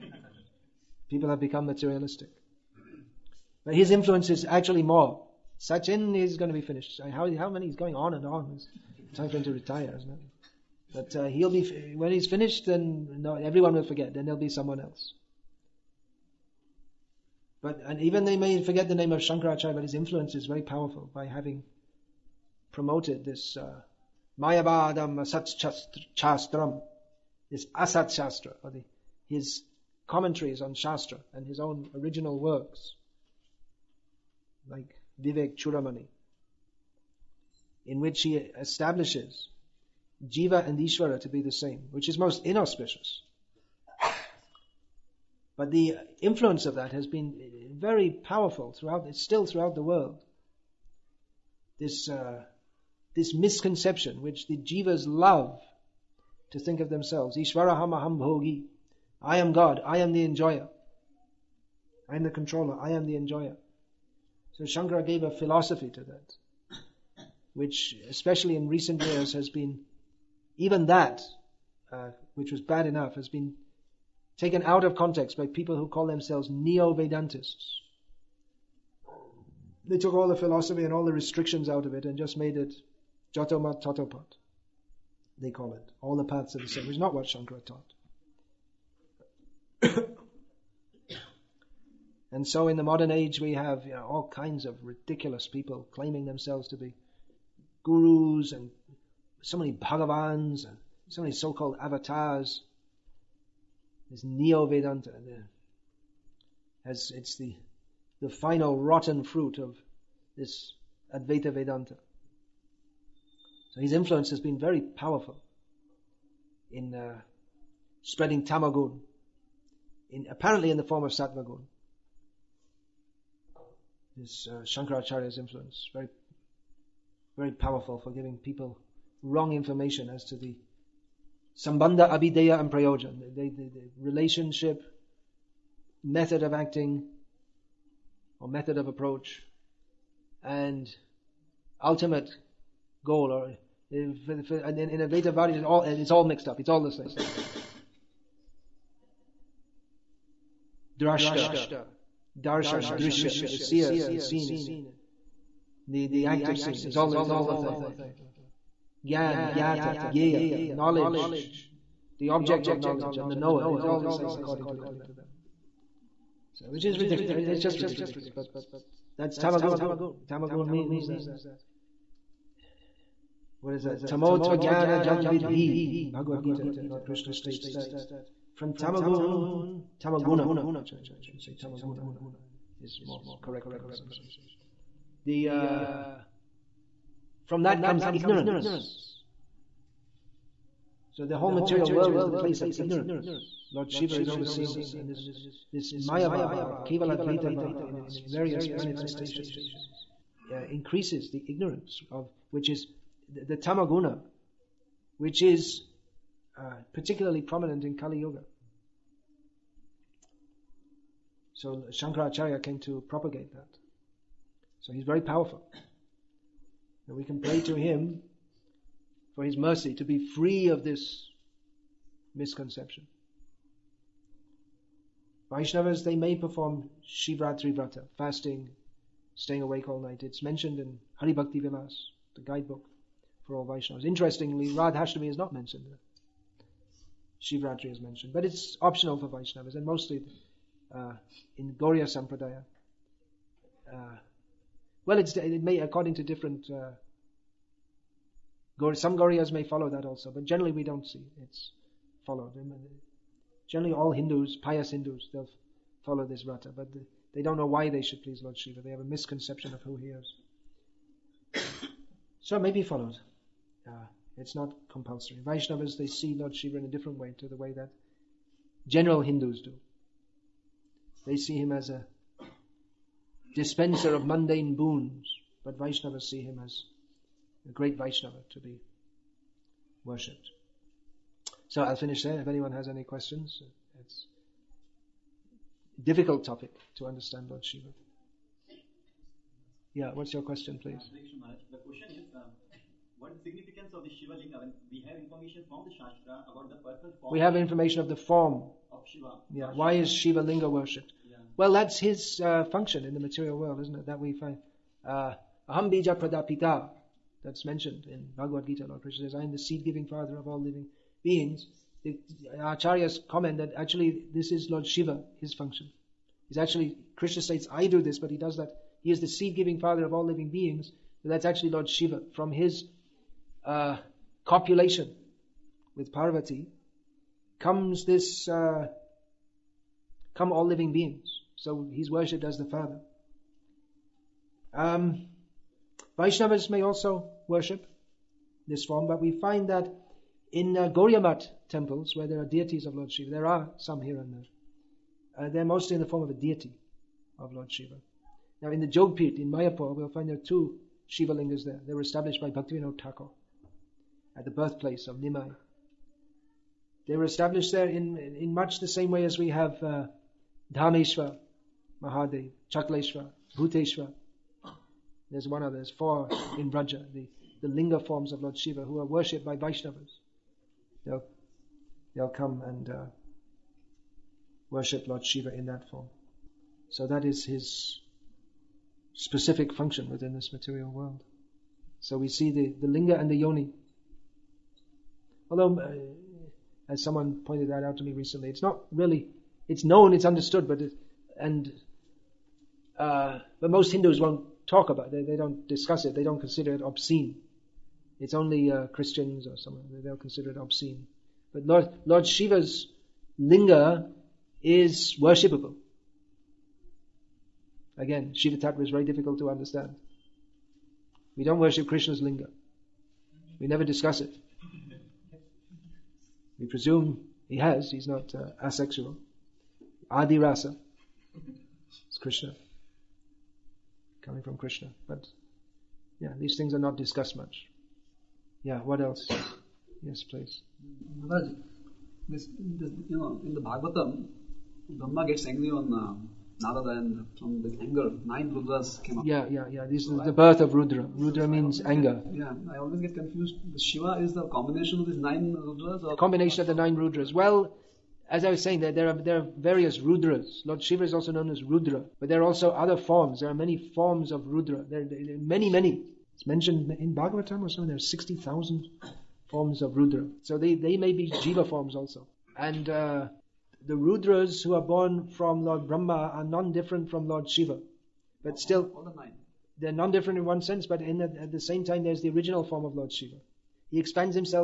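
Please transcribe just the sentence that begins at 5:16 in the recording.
He's actually Krishna states, "I do this," but he does that.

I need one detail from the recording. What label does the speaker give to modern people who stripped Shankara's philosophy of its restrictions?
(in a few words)
neo-Vedantists.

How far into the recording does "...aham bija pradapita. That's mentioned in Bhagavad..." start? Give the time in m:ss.
5:05.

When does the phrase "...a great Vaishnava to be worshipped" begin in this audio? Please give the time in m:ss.
4:37.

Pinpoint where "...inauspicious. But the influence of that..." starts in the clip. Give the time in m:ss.
0:42.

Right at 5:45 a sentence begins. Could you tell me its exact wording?
Uh, they're mostly in the form of a deity of Lord Shiva.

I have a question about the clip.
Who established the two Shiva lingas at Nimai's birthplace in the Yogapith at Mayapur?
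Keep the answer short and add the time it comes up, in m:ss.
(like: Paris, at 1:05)
Bhaktivinoda Thakur, at 5:52.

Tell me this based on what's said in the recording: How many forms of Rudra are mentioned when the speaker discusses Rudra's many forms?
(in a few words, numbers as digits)
60,000.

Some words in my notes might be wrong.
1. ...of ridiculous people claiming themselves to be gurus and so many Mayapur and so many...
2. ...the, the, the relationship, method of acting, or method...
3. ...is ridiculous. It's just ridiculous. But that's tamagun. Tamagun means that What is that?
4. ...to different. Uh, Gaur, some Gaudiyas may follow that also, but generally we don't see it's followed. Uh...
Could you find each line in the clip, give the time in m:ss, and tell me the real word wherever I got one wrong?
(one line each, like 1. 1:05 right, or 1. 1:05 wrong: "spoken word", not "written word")
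1. 1:34 wrong: "Bhagavans", not "Mayapur"
2. 2:13 right
3. 2:46 right
4. 4:06 right.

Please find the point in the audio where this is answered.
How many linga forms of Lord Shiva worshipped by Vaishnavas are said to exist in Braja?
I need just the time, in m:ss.
6:05.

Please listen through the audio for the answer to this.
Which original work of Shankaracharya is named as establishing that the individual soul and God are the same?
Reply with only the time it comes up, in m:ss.
0:35.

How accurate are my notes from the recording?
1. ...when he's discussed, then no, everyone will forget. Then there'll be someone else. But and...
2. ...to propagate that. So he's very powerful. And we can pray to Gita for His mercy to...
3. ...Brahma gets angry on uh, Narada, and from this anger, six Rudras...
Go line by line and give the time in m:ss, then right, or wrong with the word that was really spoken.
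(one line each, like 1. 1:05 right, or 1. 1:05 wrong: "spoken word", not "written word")
1. 0:11 wrong: "finished", not "discussed"
2. 3:32 wrong: "Him", not "Gita"
3. 7:14 wrong: "nine", not "six".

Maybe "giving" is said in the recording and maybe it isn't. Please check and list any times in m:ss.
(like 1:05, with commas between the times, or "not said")
2:08, 5:09, 5:19.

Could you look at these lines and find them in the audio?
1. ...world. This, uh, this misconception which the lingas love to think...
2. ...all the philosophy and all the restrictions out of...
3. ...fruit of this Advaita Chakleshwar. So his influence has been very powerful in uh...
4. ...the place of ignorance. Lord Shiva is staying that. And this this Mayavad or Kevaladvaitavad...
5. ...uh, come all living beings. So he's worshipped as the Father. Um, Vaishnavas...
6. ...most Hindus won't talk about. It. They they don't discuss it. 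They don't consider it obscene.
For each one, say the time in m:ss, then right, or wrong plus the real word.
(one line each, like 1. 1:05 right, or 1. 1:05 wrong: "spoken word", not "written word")
1. 0:49 wrong: "jivas", not "lingas"
2. 1:20 right
3. 1:49 wrong: "Vedanta", not "Chakleshwar"
4. 3:12 wrong: "overseeing", not "staying"
5. 5:28 right
6. 6:33 right.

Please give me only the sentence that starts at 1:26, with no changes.
All the paths of the soul which is not what Shankara taught.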